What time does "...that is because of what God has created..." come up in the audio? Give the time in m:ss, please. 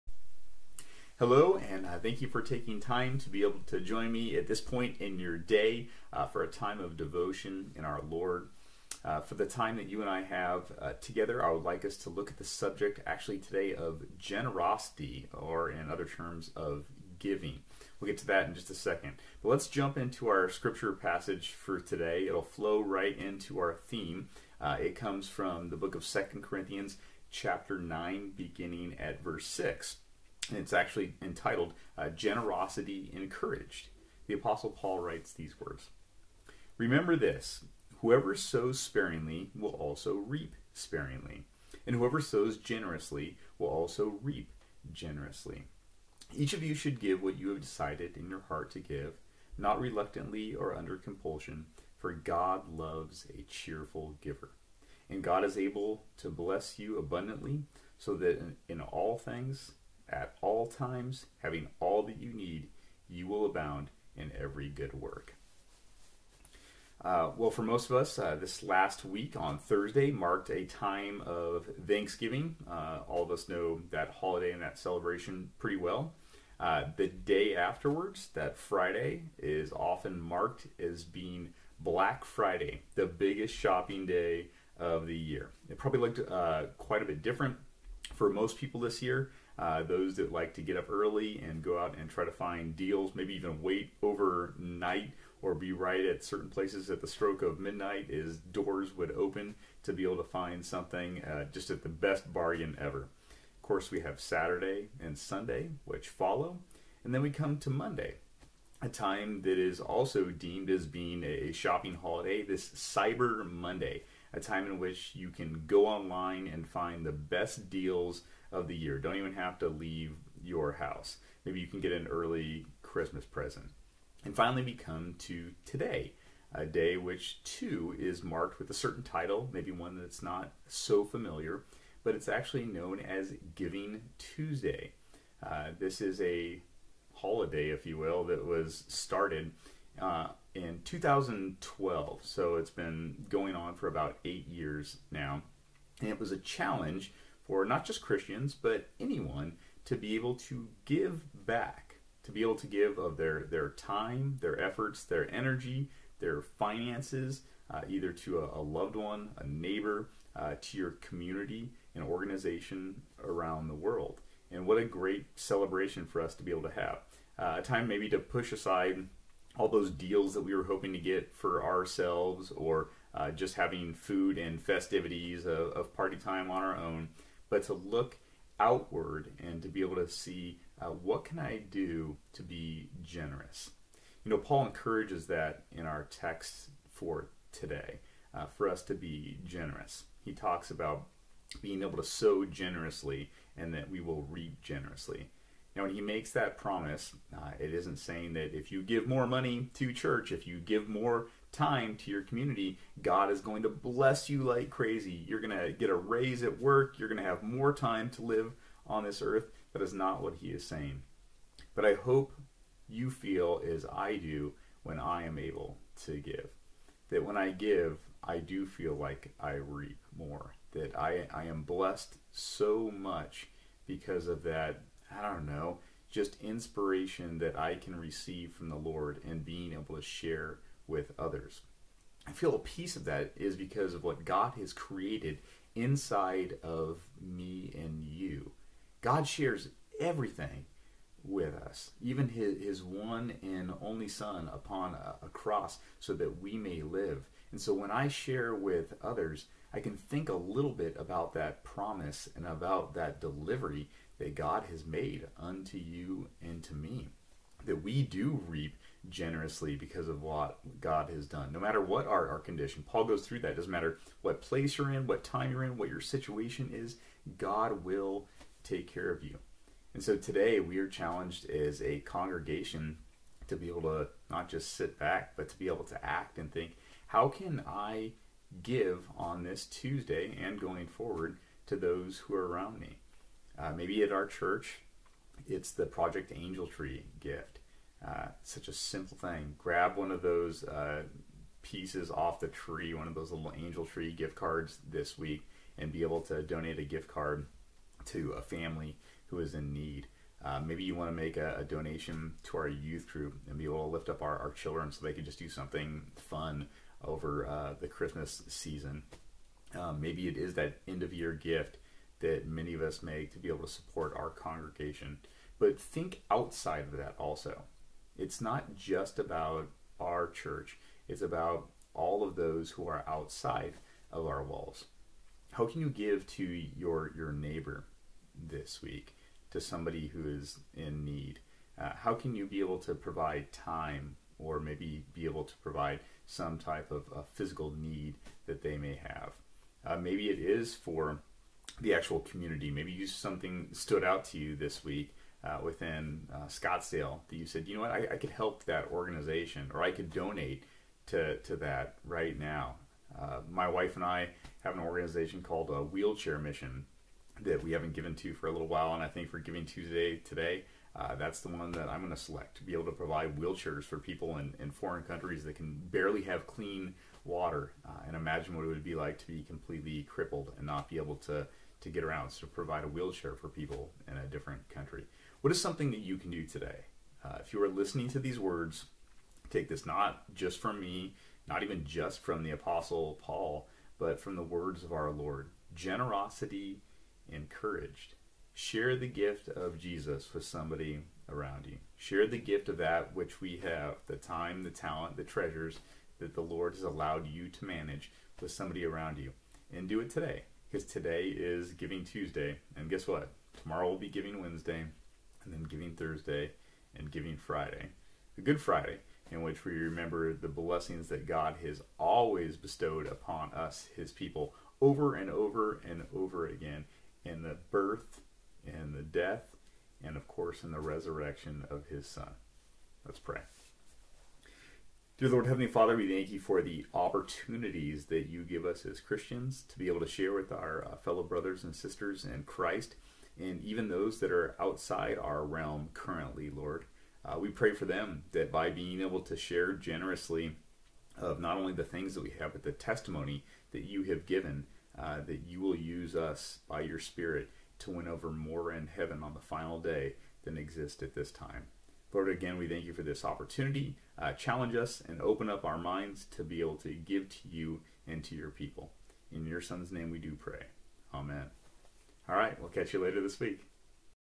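3:53.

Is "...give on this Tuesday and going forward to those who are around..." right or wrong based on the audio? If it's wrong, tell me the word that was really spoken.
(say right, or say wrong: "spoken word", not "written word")
right.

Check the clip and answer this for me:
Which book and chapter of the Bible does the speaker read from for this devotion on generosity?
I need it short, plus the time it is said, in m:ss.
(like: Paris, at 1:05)
Second Corinthians 9, at 0:26.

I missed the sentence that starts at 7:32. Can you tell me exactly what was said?
Lord, again, we thank you for this opportunity.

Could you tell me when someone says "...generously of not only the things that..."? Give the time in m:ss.
7:19.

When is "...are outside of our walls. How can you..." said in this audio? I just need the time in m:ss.
5:22.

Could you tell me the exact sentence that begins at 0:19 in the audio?
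But let's jump into our scripture passage for today.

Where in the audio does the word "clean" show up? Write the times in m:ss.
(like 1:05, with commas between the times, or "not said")
6:06.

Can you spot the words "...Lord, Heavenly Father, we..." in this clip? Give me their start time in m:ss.
7:05.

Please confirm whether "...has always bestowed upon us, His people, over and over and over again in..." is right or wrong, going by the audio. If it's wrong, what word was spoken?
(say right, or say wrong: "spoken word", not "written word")
right.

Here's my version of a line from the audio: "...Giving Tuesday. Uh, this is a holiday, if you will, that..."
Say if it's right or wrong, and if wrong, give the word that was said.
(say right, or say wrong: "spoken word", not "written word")
right.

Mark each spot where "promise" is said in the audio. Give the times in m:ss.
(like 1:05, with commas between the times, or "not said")
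3:16, 4:11.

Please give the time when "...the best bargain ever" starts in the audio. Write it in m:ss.
1:41.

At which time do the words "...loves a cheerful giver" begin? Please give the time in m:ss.
0:52.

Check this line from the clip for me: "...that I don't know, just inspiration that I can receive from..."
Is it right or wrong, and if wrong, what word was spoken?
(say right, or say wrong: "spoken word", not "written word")
right.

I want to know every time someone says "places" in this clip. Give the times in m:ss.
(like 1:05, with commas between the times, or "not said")
1:36, 4:24.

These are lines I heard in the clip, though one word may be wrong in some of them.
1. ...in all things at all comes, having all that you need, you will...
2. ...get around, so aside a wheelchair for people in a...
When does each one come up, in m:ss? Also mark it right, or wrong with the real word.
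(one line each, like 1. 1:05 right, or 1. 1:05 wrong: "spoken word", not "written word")
1. 0:58 wrong: "times", not "comes"
2. 6:11 wrong: "provide", not "aside".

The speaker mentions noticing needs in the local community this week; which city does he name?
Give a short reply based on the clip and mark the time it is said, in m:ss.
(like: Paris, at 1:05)
Scottsdale, at 5:46.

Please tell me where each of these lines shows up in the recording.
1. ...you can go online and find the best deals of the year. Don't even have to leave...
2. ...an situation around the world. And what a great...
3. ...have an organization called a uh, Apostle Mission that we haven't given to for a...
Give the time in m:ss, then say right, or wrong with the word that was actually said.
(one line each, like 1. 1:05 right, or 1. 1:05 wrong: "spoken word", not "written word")
1. 1:55 right
2. 2:41 wrong: "organization", not "situation"
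3. 5:54 wrong: "Wheelchair", not "Apostle".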